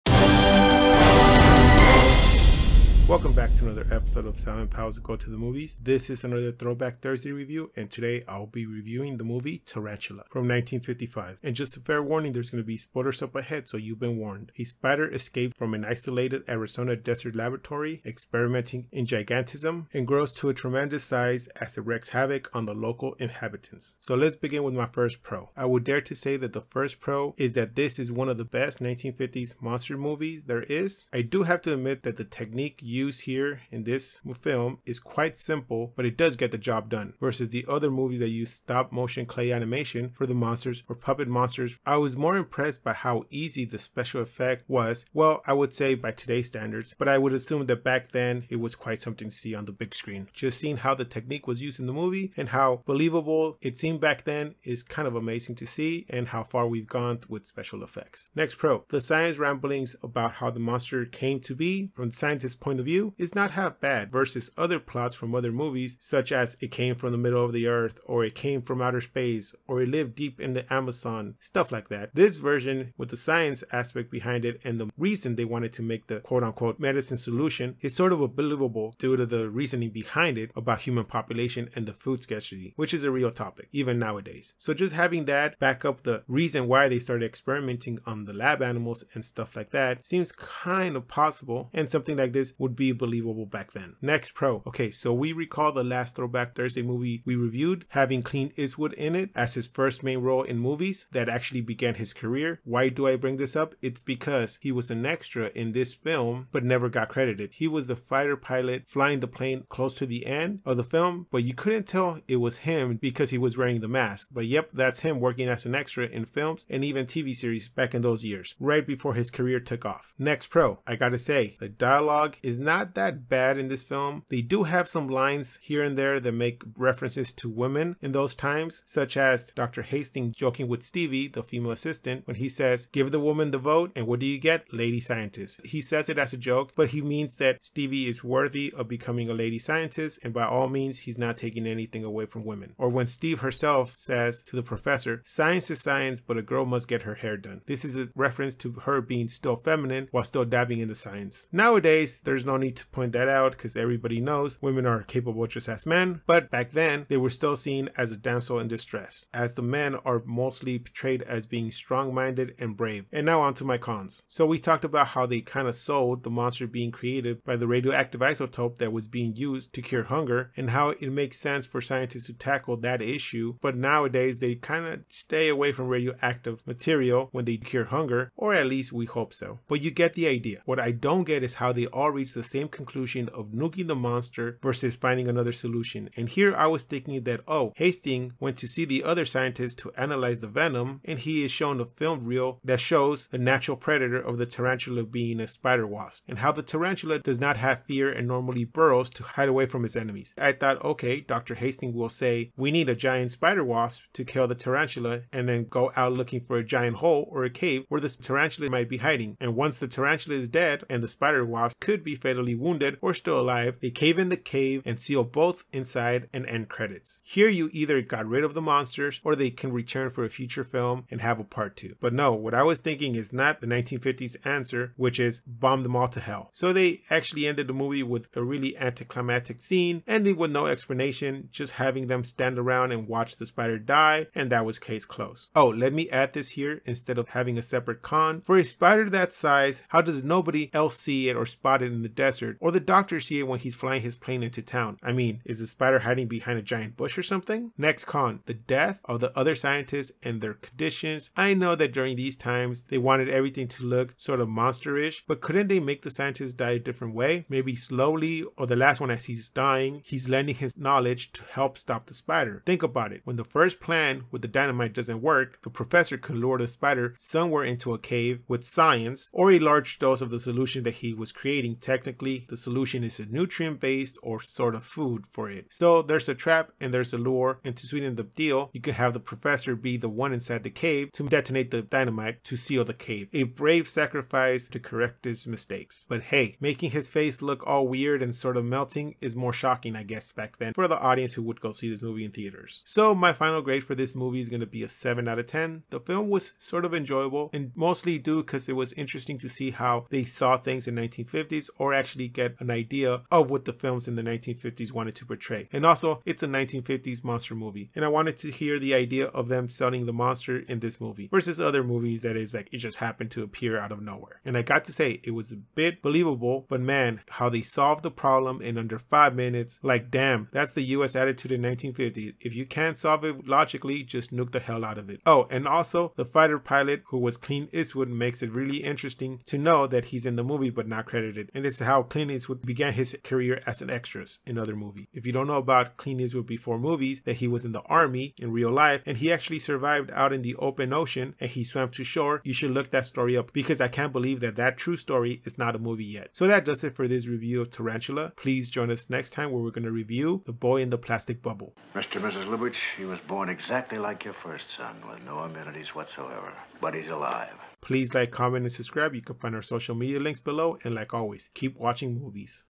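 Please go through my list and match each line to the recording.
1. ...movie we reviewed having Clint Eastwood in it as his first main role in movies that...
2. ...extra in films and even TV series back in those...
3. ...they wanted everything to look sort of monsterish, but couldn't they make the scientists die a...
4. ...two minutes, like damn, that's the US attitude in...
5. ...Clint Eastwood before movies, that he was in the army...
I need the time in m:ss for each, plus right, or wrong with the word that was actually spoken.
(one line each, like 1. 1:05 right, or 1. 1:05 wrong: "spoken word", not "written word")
1. 1:36 right
2. 1:55 right
3. 4:12 right
4. 5:18 wrong: "five", not "two"
5. 5:35 right.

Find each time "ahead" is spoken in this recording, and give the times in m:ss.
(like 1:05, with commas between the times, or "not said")
0:13.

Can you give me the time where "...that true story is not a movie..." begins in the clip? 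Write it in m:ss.
5:44.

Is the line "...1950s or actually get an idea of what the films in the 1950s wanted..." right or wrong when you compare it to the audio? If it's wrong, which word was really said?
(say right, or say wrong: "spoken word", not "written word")
right.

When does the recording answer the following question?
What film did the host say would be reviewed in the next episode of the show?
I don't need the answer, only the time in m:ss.
5:50.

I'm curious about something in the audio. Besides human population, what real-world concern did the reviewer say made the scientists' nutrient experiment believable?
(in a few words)
food scarcity.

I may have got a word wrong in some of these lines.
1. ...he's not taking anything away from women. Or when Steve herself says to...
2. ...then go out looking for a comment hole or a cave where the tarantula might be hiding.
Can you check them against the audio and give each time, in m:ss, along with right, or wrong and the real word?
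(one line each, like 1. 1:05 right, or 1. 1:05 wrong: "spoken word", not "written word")
1. 2:20 right
2. 3:25 wrong: "giant", not "comment".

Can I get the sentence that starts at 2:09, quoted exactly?
Hastings joking with Stevie, the female assistant, when he says, Give the woman the vote, and what do you get?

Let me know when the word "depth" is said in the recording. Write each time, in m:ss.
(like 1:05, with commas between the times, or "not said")
not said.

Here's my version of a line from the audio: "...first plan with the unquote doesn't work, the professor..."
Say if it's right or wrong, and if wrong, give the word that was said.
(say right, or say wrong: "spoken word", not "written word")
wrong: "dynamite", not "unquote".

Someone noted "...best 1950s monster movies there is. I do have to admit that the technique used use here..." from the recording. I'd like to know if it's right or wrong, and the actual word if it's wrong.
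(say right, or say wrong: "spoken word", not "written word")
right.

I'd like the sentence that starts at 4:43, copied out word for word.
A brave sacrifice to correct his mistakes.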